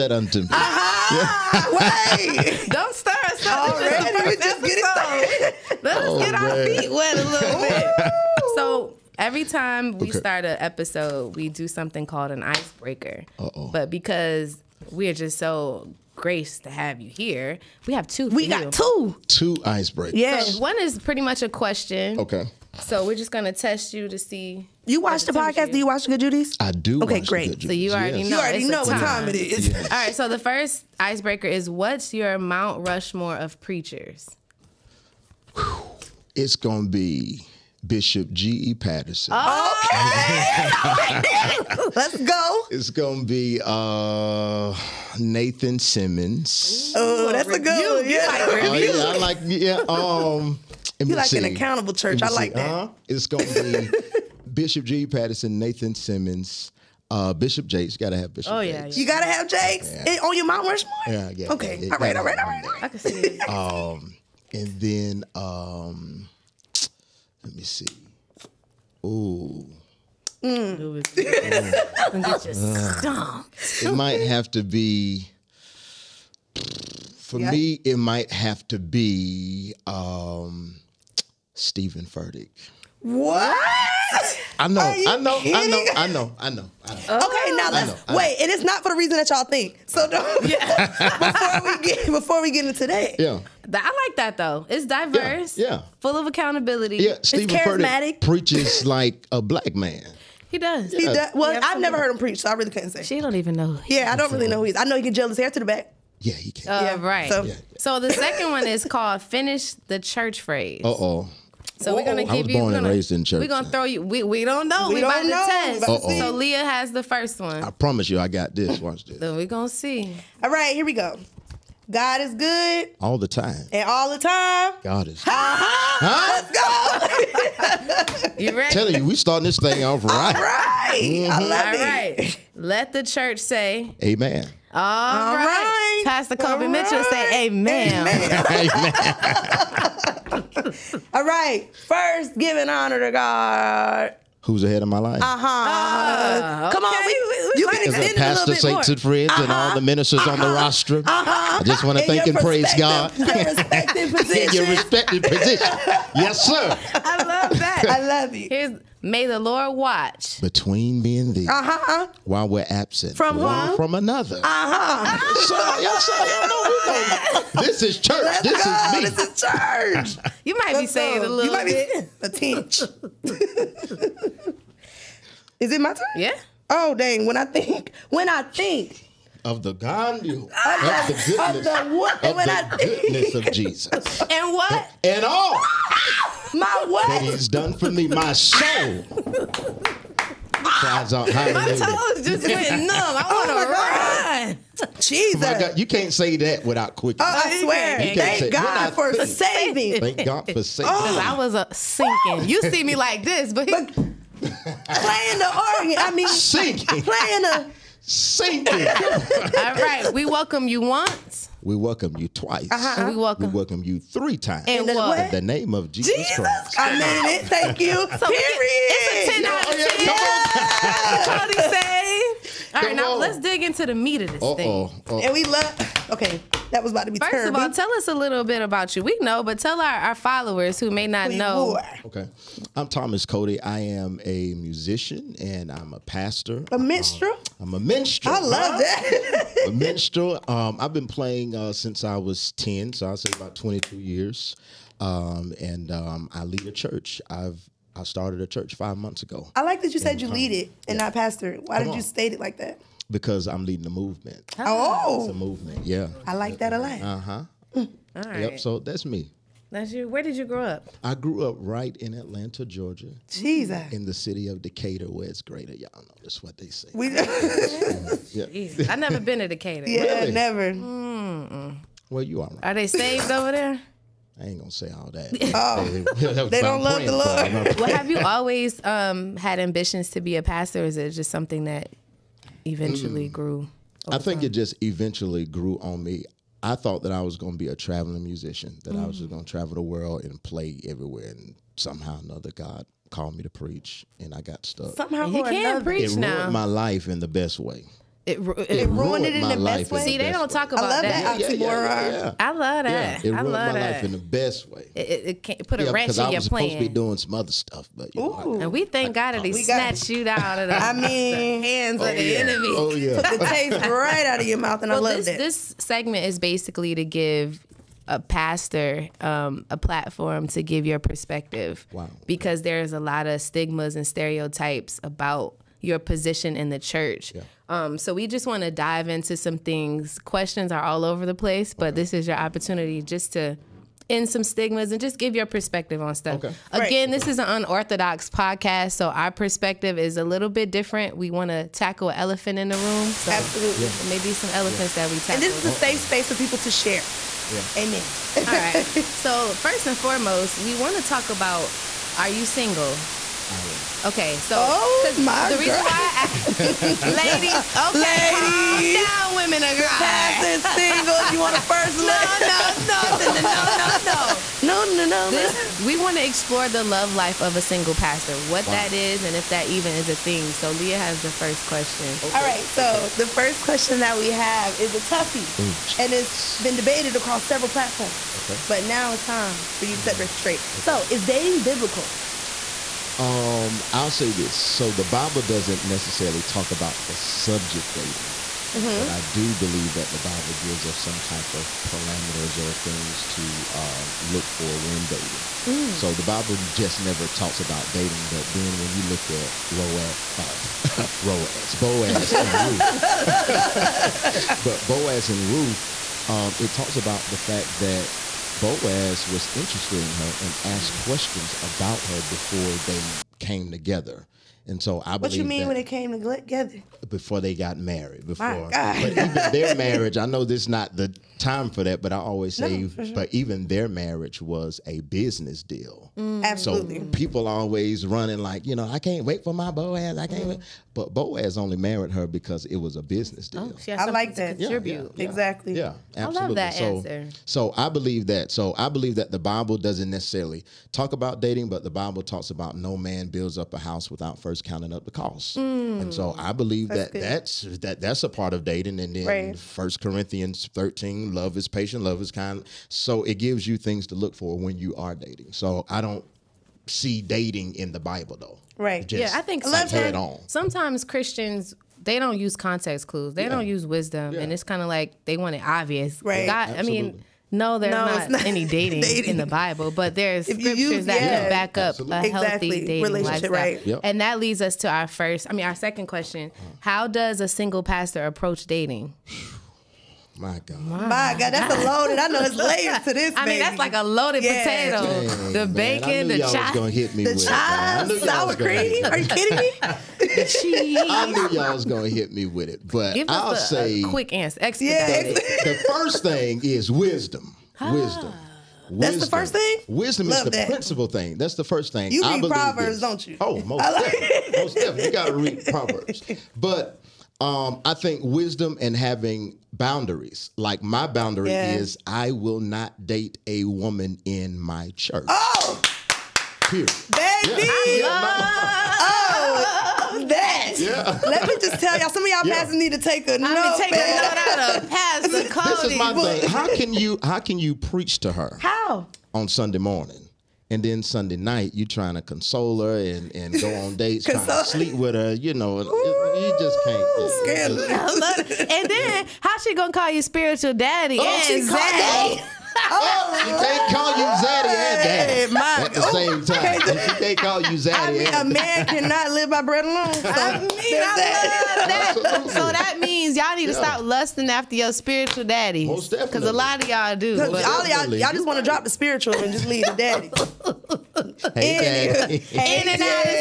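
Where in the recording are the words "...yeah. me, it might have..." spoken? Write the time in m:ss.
1:17.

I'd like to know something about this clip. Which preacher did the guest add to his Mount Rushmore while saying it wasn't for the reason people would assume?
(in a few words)
Stephen Furtick.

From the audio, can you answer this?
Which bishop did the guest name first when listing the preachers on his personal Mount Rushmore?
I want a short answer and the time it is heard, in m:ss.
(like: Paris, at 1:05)
G. E. Patterson, at 0:37.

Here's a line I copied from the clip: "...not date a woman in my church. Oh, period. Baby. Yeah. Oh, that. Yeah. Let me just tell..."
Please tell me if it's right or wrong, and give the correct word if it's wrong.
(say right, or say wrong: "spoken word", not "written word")
right.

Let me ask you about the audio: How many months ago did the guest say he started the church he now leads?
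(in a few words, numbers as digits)
5.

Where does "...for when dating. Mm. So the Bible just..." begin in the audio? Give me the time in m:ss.
6:34.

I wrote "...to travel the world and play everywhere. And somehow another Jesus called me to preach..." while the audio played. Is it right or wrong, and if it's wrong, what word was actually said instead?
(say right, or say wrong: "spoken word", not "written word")
wrong: "God", not "Jesus".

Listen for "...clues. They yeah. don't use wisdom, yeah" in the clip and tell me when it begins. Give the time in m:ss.
7:43.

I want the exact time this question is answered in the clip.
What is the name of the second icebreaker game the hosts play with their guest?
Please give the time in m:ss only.
1:49.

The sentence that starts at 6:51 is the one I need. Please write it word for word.
questions about her before they came together.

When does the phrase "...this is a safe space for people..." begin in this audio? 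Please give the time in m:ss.
5:45.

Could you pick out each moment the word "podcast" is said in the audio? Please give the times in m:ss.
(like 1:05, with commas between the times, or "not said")
0:25, 5:38.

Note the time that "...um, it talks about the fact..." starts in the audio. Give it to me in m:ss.
6:46.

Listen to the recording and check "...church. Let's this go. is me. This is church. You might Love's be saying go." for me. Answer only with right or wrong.
wrong.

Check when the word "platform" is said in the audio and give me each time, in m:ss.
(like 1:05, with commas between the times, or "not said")
5:19, 6:17.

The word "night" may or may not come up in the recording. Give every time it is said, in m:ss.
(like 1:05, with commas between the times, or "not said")
8:51.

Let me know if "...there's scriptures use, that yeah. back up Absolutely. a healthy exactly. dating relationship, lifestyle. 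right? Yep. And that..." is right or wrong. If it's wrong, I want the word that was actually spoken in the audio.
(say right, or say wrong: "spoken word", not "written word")
right.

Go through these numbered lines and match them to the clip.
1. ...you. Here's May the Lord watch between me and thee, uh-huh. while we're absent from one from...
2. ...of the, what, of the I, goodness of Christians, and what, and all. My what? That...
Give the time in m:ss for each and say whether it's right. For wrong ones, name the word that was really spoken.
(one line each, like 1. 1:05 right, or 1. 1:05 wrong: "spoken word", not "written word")
1. 2:38 right
2. 3:01 wrong: "Jesus", not "Christians".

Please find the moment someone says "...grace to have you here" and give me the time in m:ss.
0:16.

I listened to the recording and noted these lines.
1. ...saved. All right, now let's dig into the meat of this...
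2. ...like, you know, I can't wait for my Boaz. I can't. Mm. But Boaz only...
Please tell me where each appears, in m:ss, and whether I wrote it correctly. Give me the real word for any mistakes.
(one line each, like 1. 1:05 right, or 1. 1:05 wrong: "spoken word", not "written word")
1. 3:41 right
2. 7:08 right.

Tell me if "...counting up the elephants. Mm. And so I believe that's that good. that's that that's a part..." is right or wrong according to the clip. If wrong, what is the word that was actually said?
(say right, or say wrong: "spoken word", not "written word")
wrong: "costs", not "elephants".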